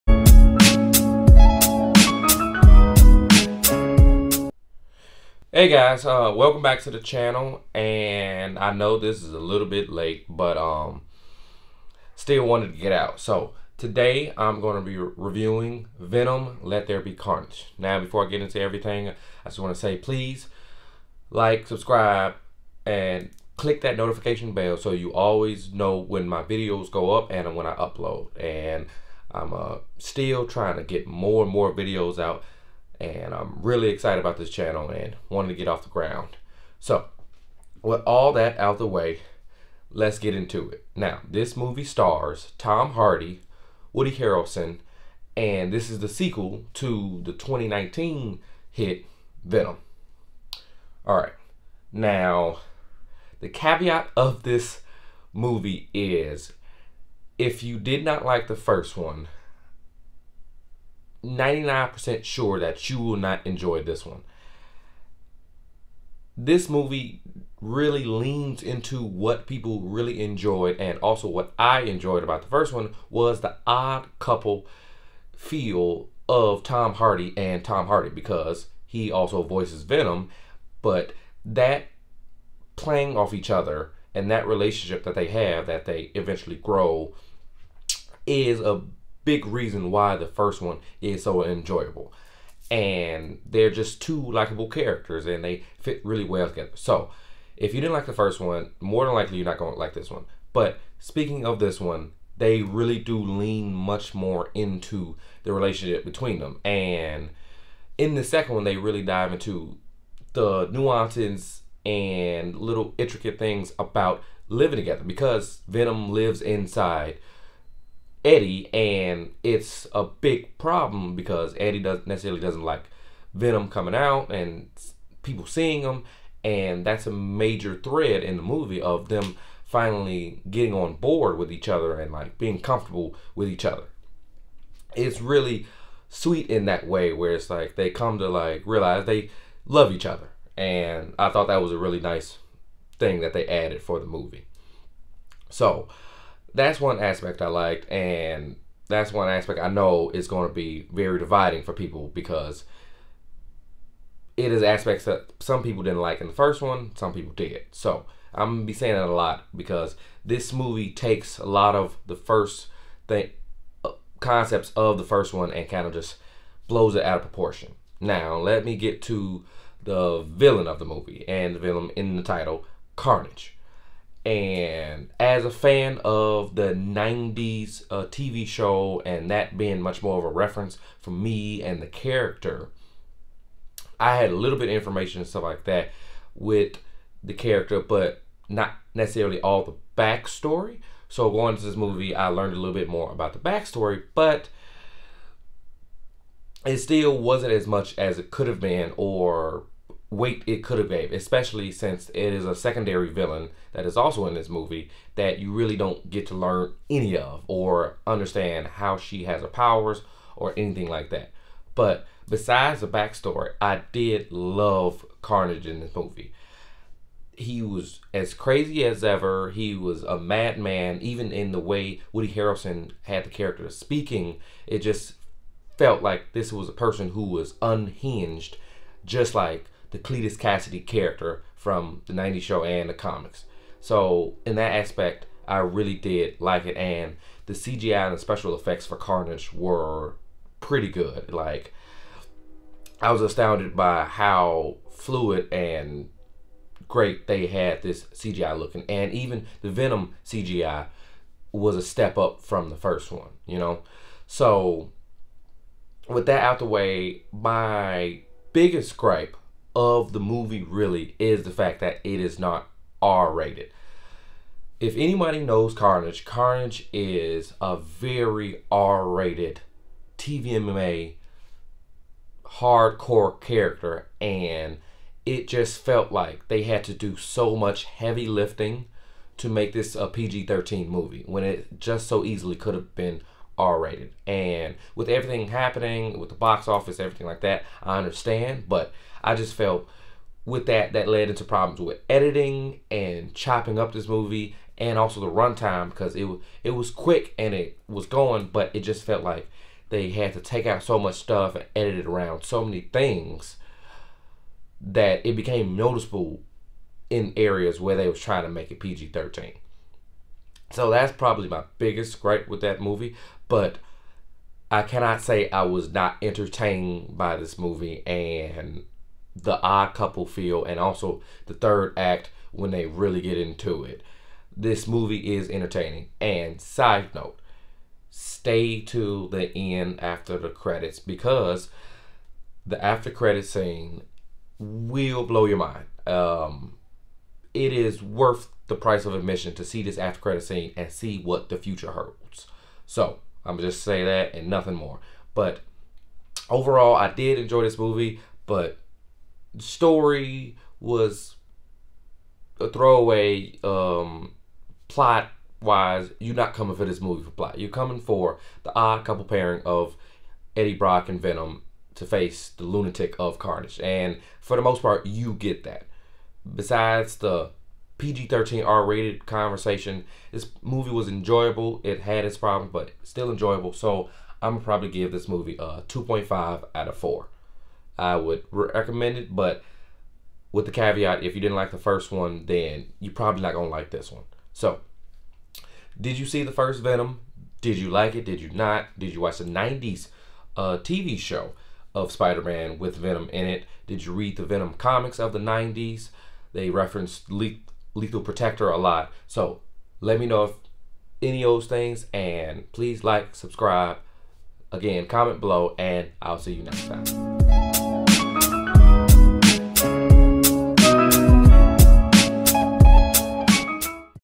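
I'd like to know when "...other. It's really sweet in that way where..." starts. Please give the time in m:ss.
2:13.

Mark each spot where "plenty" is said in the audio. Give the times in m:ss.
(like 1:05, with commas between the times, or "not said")
not said.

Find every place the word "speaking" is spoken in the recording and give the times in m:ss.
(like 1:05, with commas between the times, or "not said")
1:40, 3:43.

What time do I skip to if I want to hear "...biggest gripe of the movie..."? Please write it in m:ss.
4:18.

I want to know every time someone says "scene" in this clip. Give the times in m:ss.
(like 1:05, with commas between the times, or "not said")
5:33, 5:40.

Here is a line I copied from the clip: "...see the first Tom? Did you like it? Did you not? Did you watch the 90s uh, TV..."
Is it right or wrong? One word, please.
wrong.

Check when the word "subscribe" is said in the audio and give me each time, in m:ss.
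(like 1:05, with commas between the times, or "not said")
0:21, 6:43.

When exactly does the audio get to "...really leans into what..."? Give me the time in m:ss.
1:07.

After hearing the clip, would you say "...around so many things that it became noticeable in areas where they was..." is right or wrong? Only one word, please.
right.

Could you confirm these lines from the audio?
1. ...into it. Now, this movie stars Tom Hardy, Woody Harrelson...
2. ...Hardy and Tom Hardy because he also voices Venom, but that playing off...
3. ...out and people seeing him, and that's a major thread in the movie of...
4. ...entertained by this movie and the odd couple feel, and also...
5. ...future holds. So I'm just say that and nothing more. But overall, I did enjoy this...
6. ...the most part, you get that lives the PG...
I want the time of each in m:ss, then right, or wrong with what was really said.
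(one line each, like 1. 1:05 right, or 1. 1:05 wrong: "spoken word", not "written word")
1. 0:40 right
2. 1:16 right
3. 2:03 right
4. 5:16 right
5. 5:41 right
6. 6:04 wrong: "besides", not "lives".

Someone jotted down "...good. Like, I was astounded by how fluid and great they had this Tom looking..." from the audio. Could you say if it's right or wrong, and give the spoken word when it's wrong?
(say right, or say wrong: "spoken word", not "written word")
wrong: "CGI", not "Tom".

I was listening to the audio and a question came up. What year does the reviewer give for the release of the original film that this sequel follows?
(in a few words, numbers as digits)
2019.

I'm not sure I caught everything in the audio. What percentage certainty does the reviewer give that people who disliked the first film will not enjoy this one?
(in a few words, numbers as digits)
99%.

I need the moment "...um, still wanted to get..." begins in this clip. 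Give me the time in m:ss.
0:10.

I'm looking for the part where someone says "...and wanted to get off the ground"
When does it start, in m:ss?
0:34.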